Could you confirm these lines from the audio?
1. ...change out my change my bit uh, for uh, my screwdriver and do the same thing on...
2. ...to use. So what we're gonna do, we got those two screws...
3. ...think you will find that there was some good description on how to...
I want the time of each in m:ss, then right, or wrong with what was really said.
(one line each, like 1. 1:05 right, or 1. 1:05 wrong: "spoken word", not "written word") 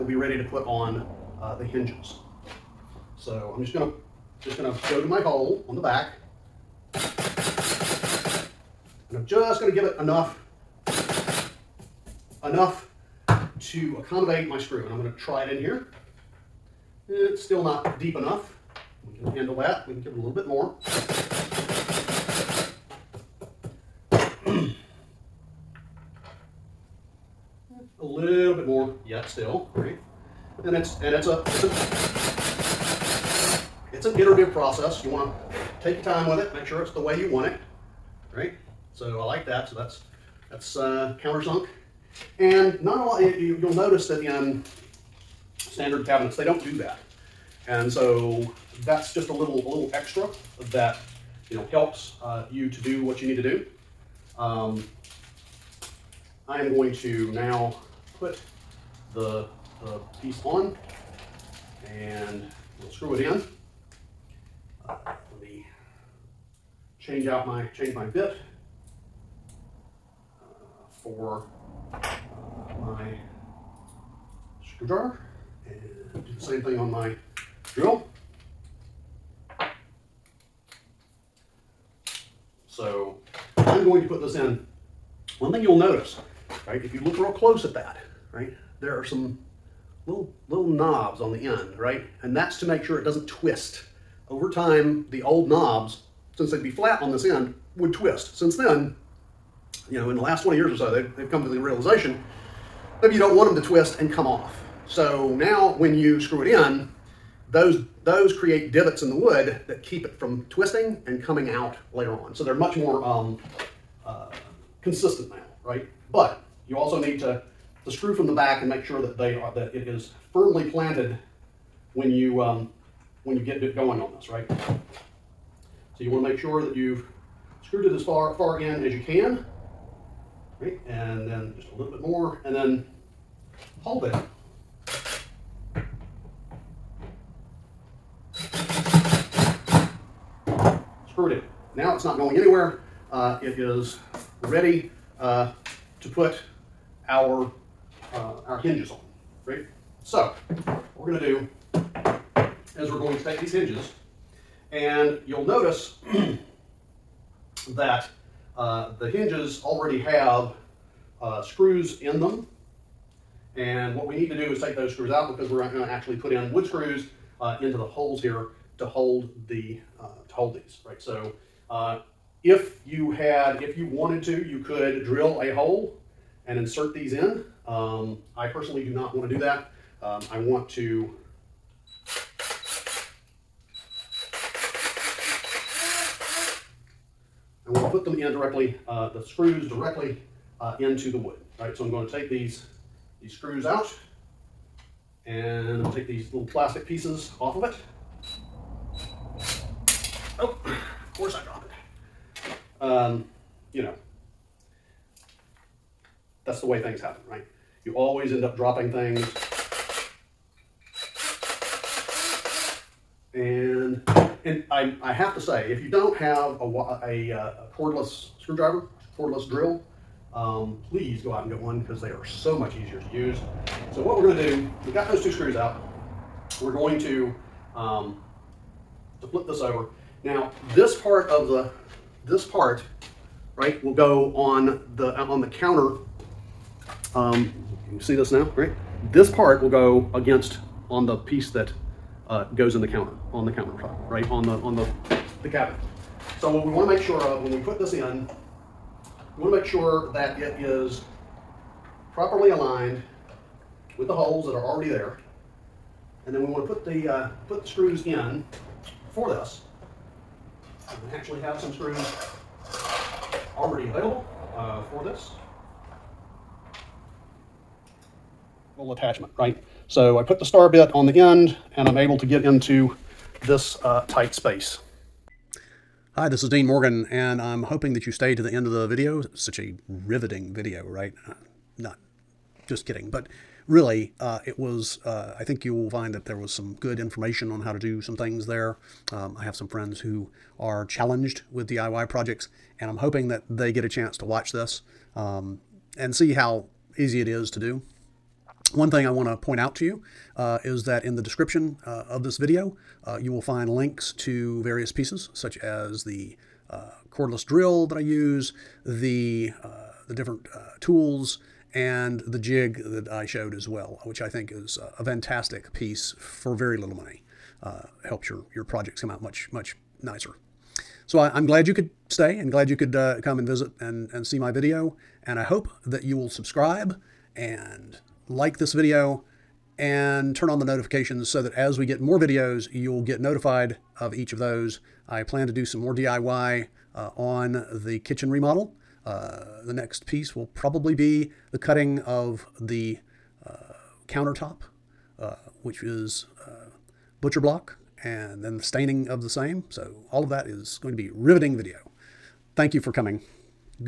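1. 1:06 right
2. 3:42 right
3. 4:45 wrong: "information", not "description".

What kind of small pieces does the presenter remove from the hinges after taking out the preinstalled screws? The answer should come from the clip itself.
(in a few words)
plastic pieces.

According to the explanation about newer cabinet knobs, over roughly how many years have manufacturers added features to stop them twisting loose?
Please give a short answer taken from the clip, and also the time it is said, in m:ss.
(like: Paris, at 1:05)
20 years, at 1:40.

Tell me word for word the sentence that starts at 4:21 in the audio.
I actually have some screws already available uh, for this.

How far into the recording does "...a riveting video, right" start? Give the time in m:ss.
4:39.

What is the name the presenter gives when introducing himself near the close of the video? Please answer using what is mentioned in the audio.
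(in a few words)
Dean Morgan.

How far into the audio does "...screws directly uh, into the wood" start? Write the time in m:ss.
3:09.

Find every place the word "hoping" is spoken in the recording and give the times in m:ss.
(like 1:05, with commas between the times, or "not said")
4:37, 4:52.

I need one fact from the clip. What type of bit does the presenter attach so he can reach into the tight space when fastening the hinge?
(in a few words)
star bit.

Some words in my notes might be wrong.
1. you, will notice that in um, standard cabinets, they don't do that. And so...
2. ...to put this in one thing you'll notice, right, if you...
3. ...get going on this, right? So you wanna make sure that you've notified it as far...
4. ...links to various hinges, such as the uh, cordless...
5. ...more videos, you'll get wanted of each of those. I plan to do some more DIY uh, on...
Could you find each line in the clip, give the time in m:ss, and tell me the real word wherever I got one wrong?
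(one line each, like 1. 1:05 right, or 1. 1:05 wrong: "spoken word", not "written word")
1. 0:43 right
2. 1:24 right
3. 2:03 wrong: "screwed", not "notified"
4. 5:03 wrong: "pieces", not "hinges"
5. 5:31 wrong: "notified", not "wanted".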